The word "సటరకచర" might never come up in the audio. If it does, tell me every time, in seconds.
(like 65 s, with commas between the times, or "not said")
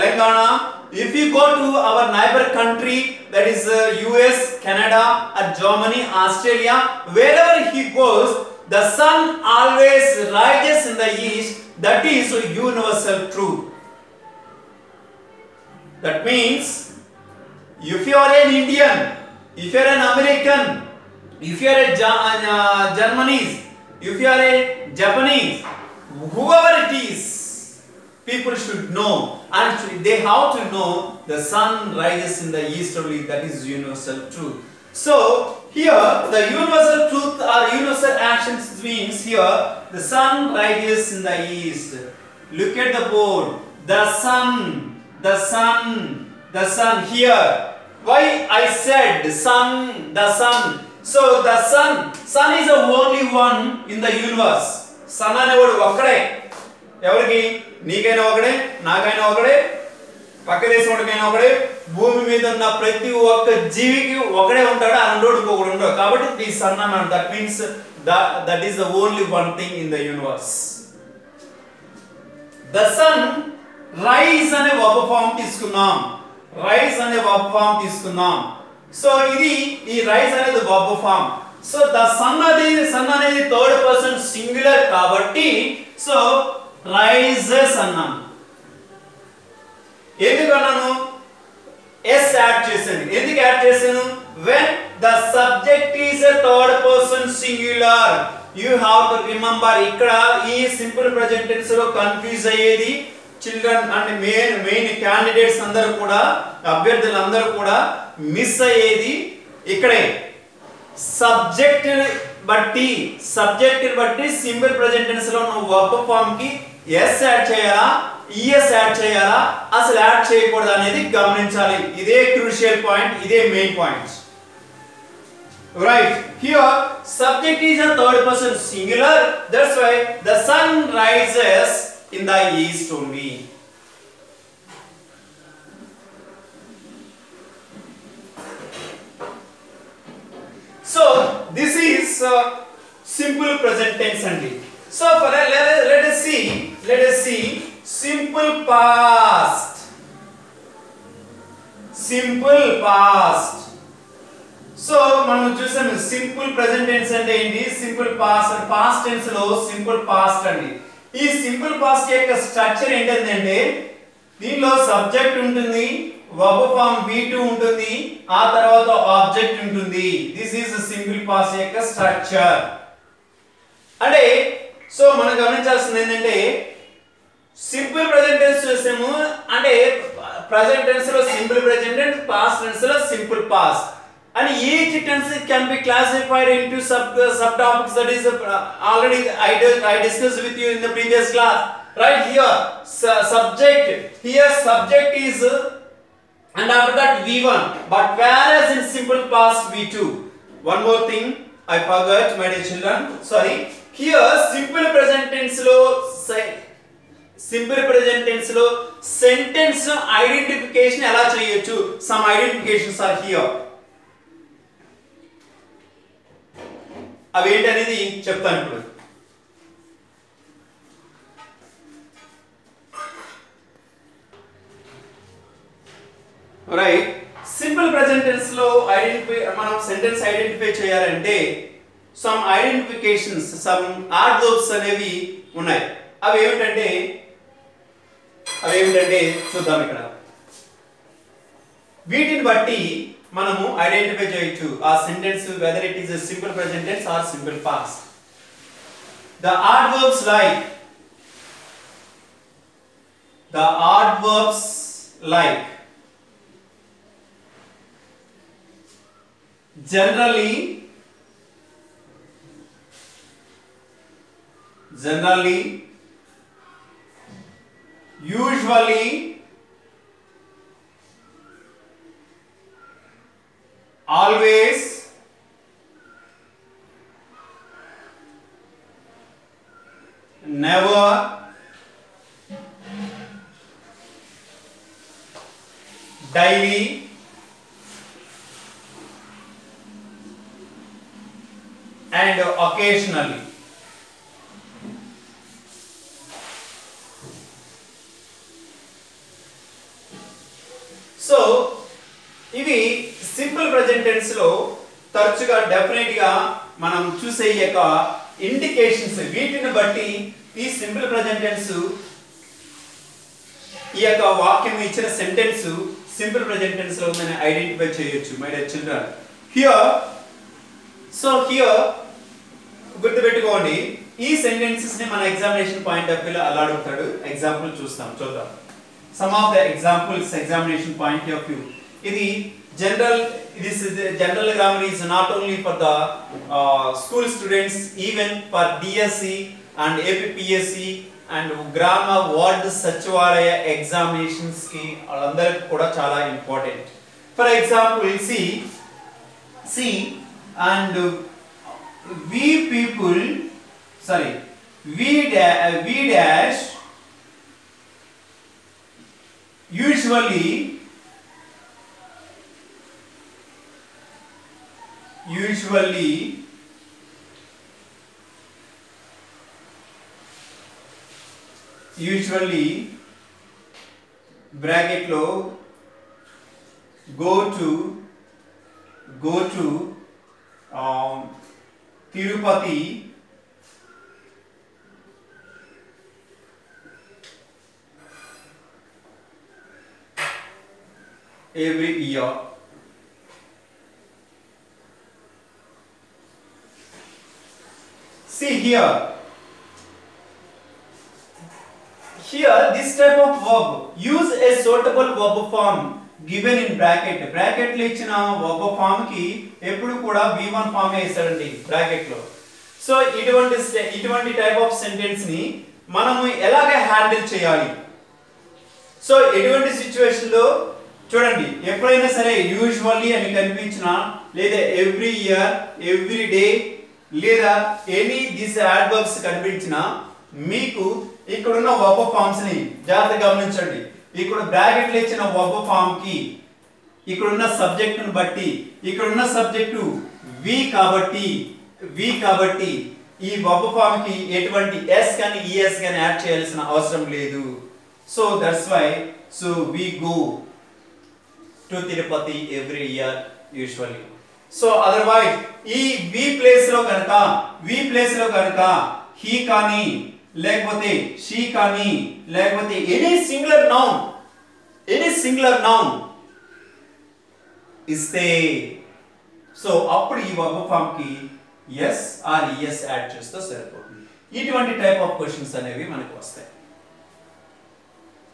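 162 s, 171 s.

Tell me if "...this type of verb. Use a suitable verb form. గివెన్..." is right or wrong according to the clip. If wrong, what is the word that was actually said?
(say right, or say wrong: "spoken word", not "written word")
right.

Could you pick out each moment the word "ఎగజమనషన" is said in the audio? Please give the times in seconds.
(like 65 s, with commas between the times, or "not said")
325 s, 330 s.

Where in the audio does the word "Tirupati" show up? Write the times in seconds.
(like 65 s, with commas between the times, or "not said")
382 s.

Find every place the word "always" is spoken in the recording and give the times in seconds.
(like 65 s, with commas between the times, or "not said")
9 s, 274 s.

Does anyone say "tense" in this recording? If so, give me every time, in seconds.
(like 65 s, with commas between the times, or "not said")
144 s, 185 s, 205 s.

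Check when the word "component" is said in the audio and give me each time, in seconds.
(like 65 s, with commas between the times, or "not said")
not said.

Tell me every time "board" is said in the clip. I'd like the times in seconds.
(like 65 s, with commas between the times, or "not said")
43 s.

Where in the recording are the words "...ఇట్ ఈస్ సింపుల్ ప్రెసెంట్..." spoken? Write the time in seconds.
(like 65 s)
245 s.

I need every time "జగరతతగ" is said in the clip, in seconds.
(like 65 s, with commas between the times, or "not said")
432 s.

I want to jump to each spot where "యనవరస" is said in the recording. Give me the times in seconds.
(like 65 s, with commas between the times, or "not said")
70 s.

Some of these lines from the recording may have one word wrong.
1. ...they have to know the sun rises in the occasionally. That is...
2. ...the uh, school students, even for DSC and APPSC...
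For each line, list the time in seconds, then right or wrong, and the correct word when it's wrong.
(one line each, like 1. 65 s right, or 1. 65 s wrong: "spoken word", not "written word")
1. 29 s wrong: "easterly", not "occasionally"
2. 335 s right.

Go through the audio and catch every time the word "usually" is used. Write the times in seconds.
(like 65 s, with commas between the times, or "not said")
268 s, 359 s, 365 s, 371 s.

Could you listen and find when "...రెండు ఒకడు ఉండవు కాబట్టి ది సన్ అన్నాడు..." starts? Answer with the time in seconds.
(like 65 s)
65 s.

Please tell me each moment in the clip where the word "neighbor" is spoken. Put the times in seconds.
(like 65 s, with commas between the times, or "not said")
2 s.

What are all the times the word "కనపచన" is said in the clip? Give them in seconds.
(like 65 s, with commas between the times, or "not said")
423 s, 429 s.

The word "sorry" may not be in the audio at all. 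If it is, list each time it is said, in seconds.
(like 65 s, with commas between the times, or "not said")
203 s, 353 s.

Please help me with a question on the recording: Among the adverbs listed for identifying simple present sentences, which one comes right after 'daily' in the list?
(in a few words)
occasionally.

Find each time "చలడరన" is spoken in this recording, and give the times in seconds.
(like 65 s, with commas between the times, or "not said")
103 s, 318 s.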